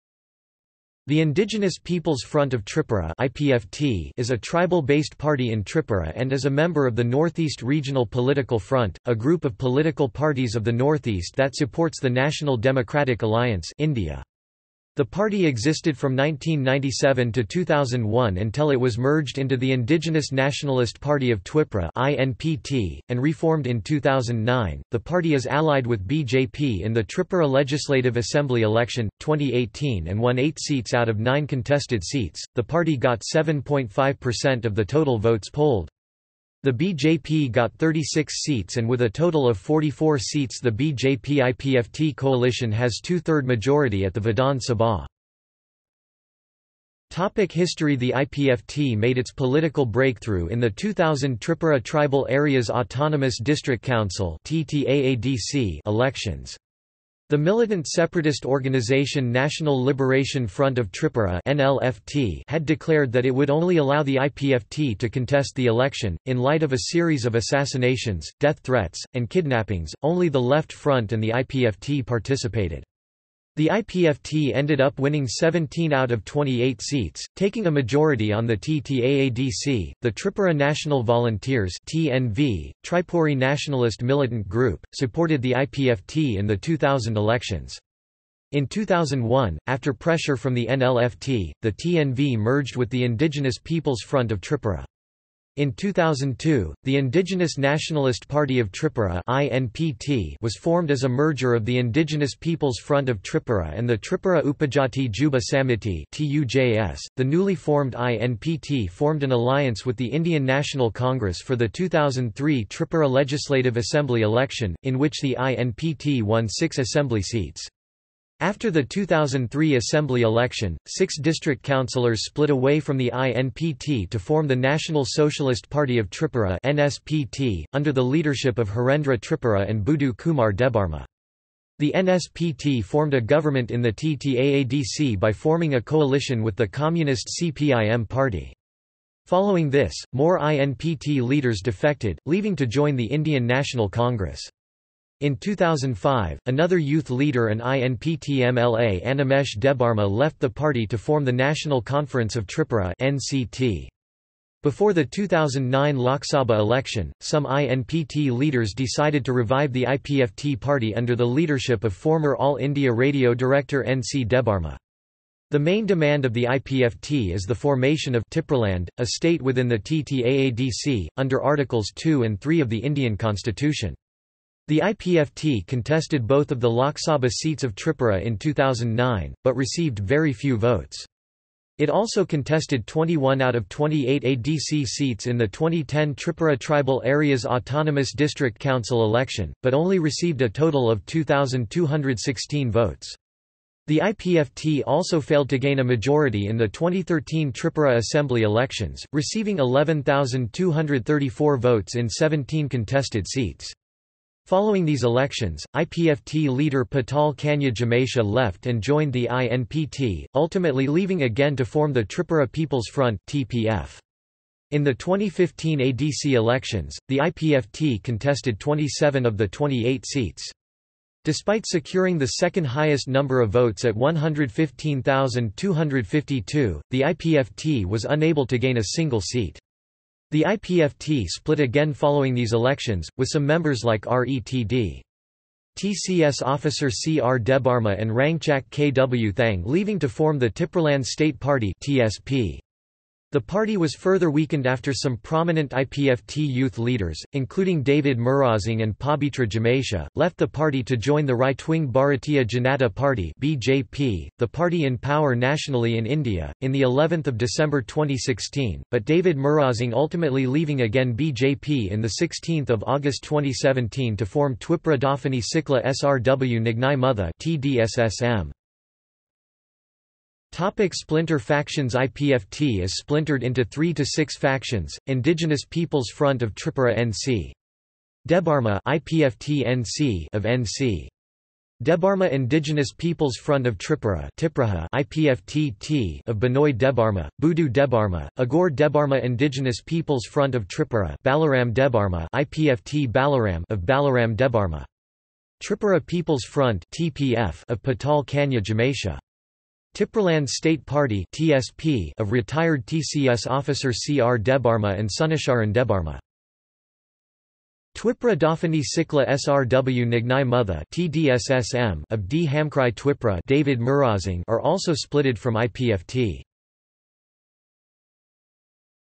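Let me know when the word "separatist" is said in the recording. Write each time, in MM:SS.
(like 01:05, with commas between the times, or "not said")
00:57.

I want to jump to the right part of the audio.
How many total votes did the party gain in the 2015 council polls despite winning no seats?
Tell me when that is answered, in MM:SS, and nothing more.
03:43.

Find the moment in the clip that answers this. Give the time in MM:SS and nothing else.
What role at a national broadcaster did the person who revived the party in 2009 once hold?
02:42.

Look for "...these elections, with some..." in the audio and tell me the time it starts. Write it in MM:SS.
03:52.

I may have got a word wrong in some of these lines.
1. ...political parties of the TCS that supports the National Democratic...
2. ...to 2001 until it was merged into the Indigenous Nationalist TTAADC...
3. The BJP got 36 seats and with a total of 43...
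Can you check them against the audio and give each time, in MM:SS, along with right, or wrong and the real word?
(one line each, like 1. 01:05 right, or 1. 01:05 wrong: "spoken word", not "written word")
1. 00:09 wrong: "Northeast", not "TCS"
2. 00:17 wrong: "Party", not "TTAADC"
3. 00:36 wrong: "44", not "43".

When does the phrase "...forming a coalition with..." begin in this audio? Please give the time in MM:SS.
02:15.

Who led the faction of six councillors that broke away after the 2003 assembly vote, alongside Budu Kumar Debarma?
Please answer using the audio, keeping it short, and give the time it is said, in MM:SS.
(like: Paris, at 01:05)
Harendra Tripura, at 02:08.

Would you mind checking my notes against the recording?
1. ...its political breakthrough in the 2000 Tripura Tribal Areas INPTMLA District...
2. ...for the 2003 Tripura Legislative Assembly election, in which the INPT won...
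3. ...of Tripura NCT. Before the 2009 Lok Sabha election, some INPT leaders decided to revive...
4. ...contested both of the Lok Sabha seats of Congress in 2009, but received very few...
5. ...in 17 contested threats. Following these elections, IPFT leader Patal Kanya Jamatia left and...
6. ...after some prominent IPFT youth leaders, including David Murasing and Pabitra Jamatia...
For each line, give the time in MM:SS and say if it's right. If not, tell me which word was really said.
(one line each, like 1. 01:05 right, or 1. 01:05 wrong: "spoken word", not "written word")
1. 00:49 wrong: "Autonomous", not "INPTMLA"
2. 01:51 right
3. 02:32 right
4. 02:55 wrong: "Tripura", not "Congress"
5. 03:21 wrong: "seats", not "threats"
6. 04:04 right.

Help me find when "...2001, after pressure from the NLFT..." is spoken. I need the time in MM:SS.
01:28.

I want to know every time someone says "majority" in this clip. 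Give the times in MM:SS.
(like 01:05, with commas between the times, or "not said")
00:43, 01:17, 03:15.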